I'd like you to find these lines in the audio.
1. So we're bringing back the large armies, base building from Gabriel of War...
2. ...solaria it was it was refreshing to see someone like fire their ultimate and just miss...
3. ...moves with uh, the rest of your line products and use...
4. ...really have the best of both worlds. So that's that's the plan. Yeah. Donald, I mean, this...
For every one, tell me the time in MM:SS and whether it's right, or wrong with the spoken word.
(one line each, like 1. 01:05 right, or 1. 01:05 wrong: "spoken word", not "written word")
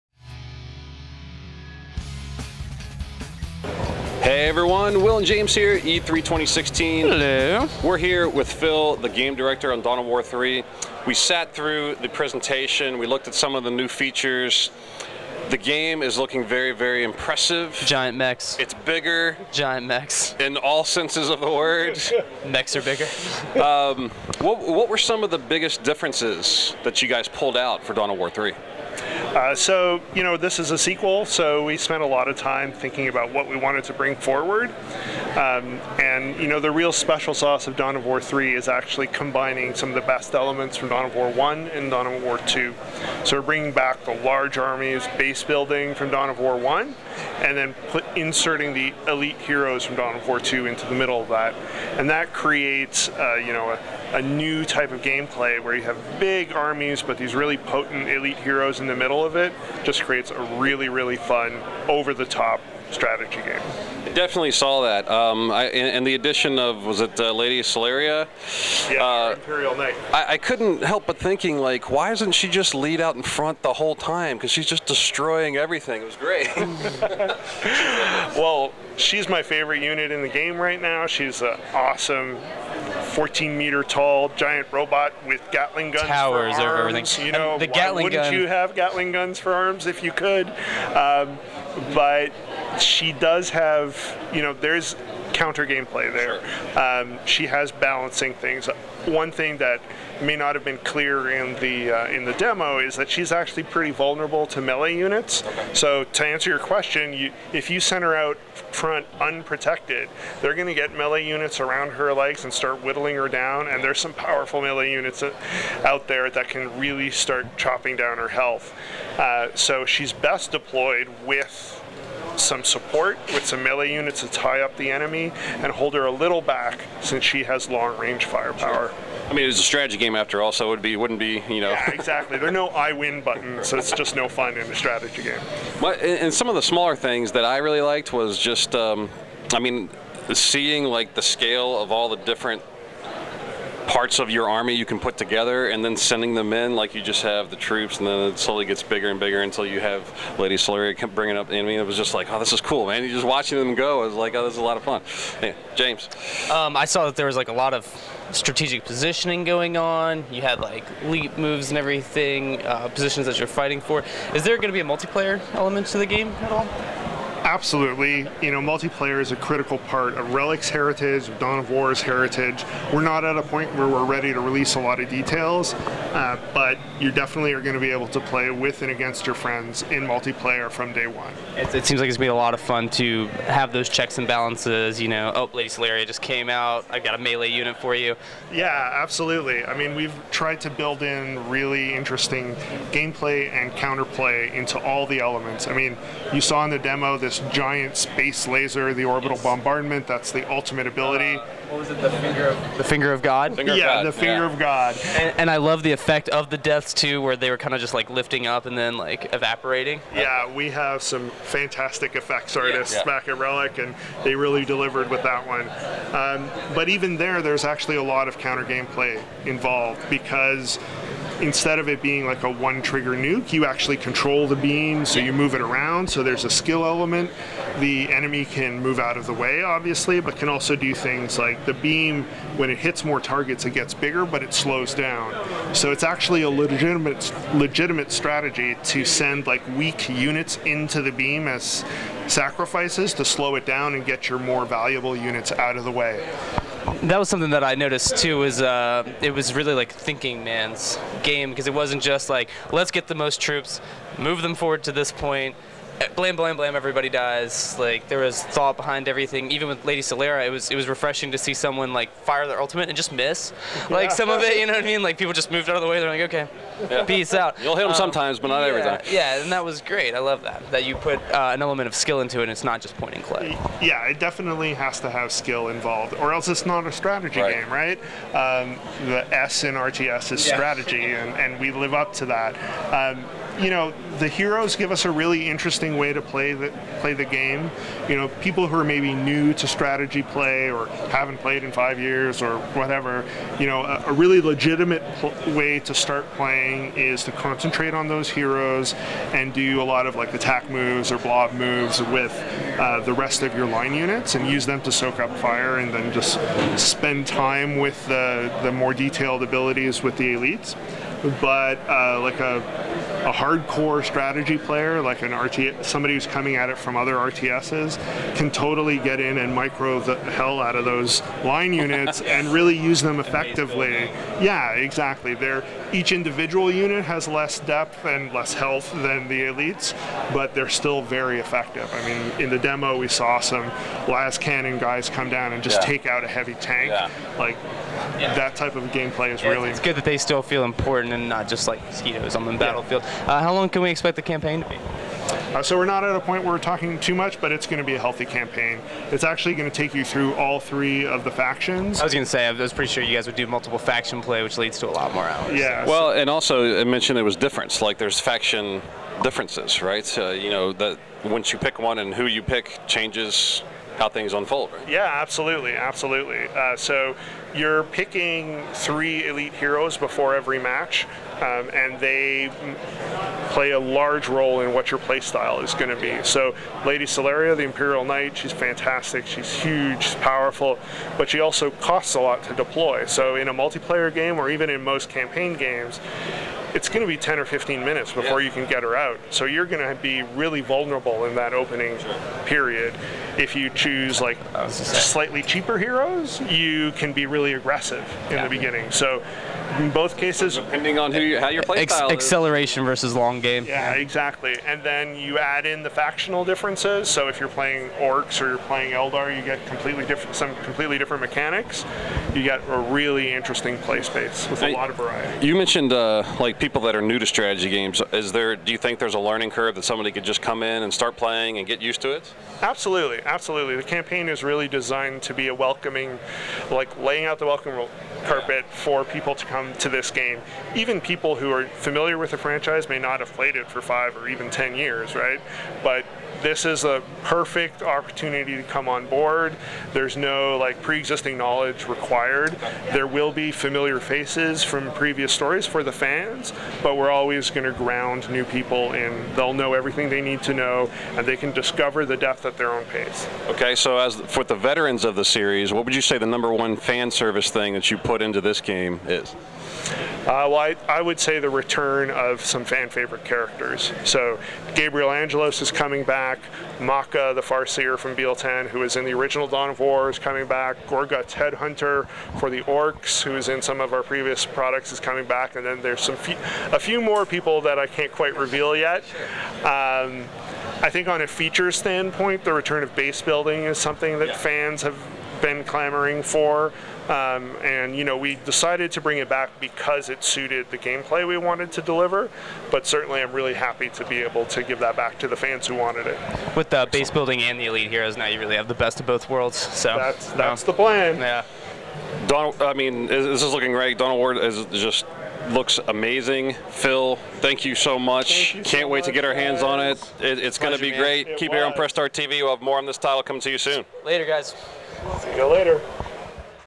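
1. 00:43 wrong: "Dawn", not "Gabriel"
2. 04:20 right
3. 05:01 wrong: "units", not "products"
4. 08:18 right.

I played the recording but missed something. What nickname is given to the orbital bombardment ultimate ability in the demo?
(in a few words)
Finger of God.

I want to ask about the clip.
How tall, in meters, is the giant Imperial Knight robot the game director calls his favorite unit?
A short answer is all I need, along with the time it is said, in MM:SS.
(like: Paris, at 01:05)
14 meters, at 01:23.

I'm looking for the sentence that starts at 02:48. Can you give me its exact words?
You know, multiplayer is a critical part of Relic's heritage, of Dawn of War's heritage.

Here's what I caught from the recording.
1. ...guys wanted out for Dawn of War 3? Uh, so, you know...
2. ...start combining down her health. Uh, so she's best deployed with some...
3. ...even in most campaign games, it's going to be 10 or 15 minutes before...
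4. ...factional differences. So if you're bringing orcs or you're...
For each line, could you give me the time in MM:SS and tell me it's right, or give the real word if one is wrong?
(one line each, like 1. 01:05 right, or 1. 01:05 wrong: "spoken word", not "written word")
1. 00:27 wrong: "pulled", not "wanted"
2. 01:57 wrong: "chopping", not "combining"
3. 06:24 right
4. 06:45 wrong: "playing", not "bringing".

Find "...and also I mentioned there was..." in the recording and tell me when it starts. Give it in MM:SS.
05:56.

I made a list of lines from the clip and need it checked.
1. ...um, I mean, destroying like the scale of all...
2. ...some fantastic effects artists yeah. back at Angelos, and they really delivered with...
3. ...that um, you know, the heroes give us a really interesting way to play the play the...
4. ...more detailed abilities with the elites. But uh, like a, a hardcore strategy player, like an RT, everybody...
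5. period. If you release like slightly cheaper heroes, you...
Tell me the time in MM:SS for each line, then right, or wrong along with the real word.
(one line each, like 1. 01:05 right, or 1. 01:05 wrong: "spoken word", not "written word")
1. 02:18 wrong: "seeing", not "destroying"
2. 03:31 wrong: "Relic", not "Angelos"
3. 04:42 right
4. 05:08 wrong: "somebody", not "everybody"
5. 06:32 wrong: "choose", not "release".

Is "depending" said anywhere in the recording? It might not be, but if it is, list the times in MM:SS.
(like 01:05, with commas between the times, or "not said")
06:40.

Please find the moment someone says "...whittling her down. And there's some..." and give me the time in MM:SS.
01:52.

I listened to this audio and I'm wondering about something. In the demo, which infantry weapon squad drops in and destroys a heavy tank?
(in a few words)
Lascannon.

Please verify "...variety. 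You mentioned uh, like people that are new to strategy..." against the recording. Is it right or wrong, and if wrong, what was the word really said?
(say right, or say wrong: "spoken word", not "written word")
right.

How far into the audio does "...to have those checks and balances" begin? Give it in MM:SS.
03:02.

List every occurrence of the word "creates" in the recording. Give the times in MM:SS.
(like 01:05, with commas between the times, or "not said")
00:52, 01:00.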